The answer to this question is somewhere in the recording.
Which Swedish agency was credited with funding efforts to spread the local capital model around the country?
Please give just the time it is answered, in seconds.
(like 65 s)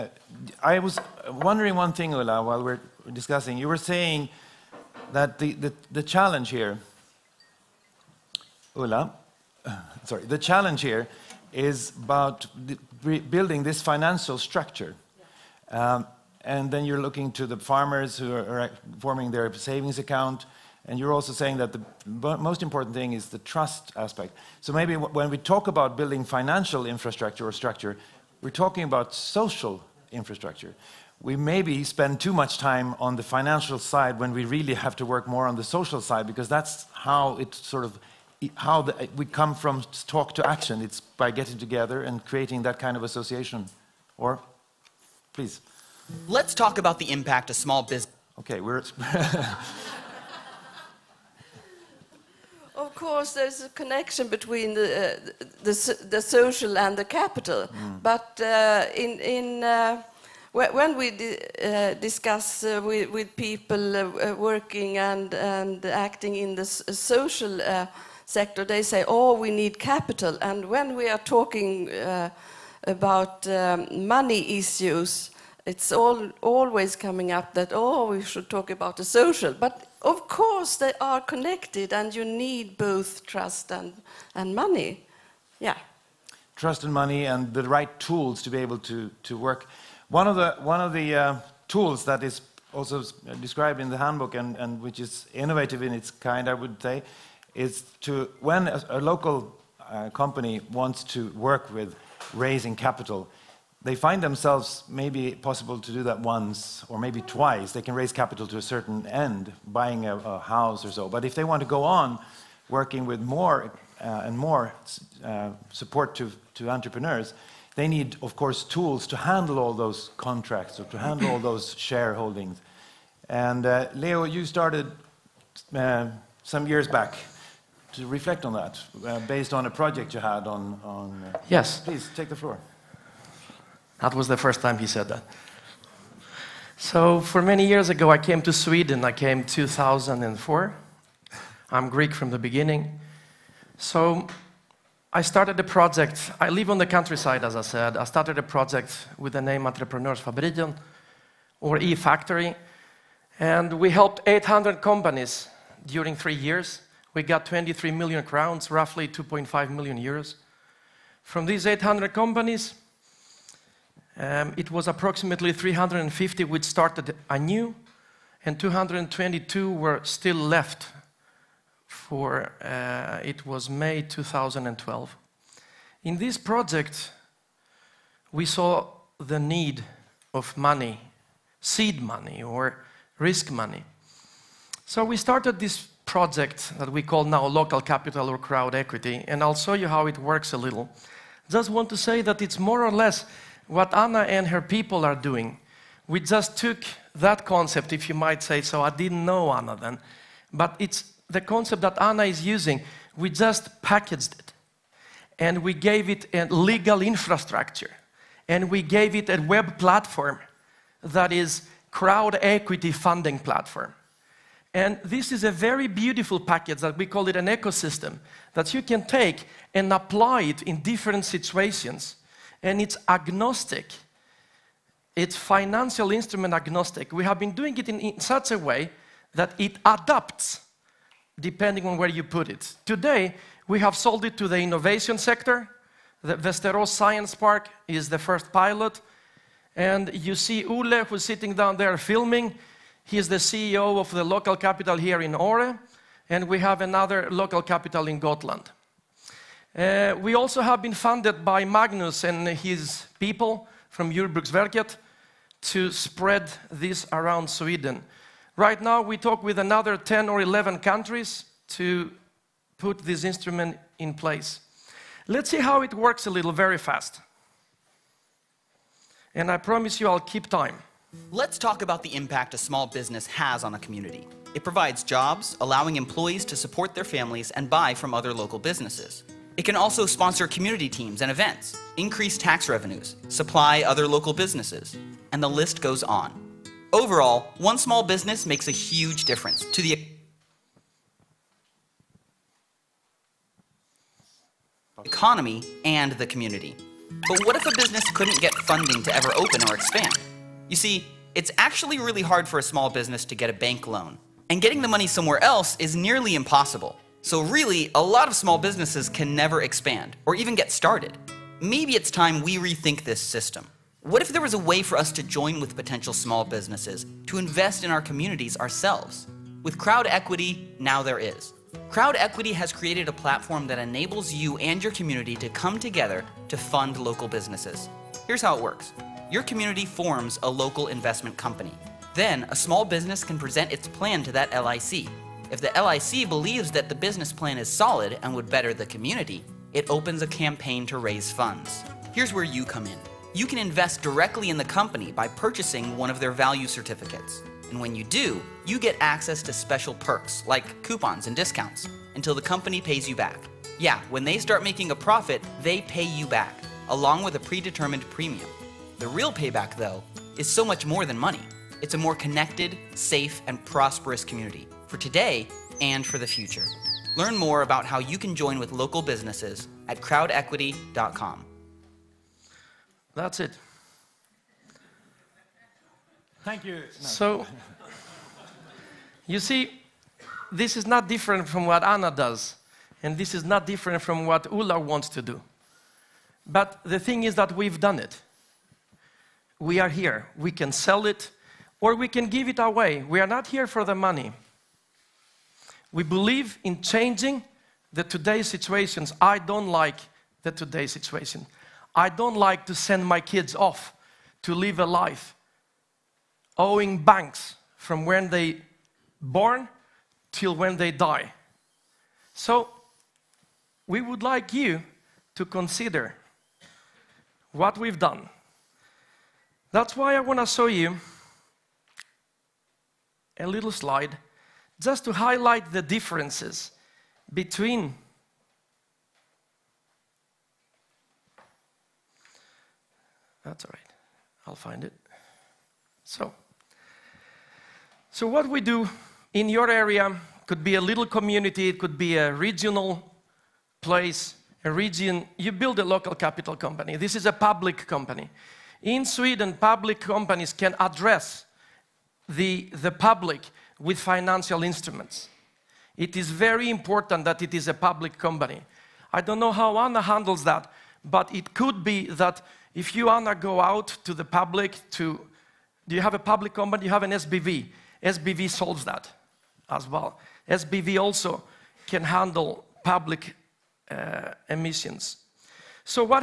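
254 s.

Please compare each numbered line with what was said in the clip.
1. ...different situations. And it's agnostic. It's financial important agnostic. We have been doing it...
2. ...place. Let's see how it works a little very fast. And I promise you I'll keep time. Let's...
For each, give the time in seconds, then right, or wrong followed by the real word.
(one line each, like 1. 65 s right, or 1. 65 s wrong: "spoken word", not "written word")
1. 220 s wrong: "instrument", not "important"
2. 264 s right.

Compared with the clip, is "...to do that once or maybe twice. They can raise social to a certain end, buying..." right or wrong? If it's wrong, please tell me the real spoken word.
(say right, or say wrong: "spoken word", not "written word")
wrong: "capital", not "social".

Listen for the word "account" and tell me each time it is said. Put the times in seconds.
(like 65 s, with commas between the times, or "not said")
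19 s.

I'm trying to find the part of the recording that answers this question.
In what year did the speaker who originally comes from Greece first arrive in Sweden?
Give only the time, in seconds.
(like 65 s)
139 s.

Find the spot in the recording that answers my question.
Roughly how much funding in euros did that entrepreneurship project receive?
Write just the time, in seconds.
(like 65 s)
159 s.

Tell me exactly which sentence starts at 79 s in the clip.
But of course, they are connected, and you need both trust and, and money.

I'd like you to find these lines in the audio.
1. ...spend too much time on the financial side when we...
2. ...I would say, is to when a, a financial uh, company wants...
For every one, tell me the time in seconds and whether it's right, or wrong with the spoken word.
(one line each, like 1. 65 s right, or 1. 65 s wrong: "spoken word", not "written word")
1. 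31 s right
2. 96 s wrong: "local", not "financial".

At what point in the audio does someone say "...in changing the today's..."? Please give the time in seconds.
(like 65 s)
396 s.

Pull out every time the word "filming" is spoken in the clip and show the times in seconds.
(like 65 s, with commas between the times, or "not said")
241 s.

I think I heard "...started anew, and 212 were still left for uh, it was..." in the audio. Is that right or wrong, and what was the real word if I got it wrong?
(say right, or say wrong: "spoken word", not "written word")
wrong: "222", not "212".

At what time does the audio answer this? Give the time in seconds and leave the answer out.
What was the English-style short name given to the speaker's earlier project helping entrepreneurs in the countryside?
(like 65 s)
151 s.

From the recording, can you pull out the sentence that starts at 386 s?
But the thing is that we've done it we are here.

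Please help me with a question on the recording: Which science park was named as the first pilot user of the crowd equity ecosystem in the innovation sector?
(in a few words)
Västerås Science Park.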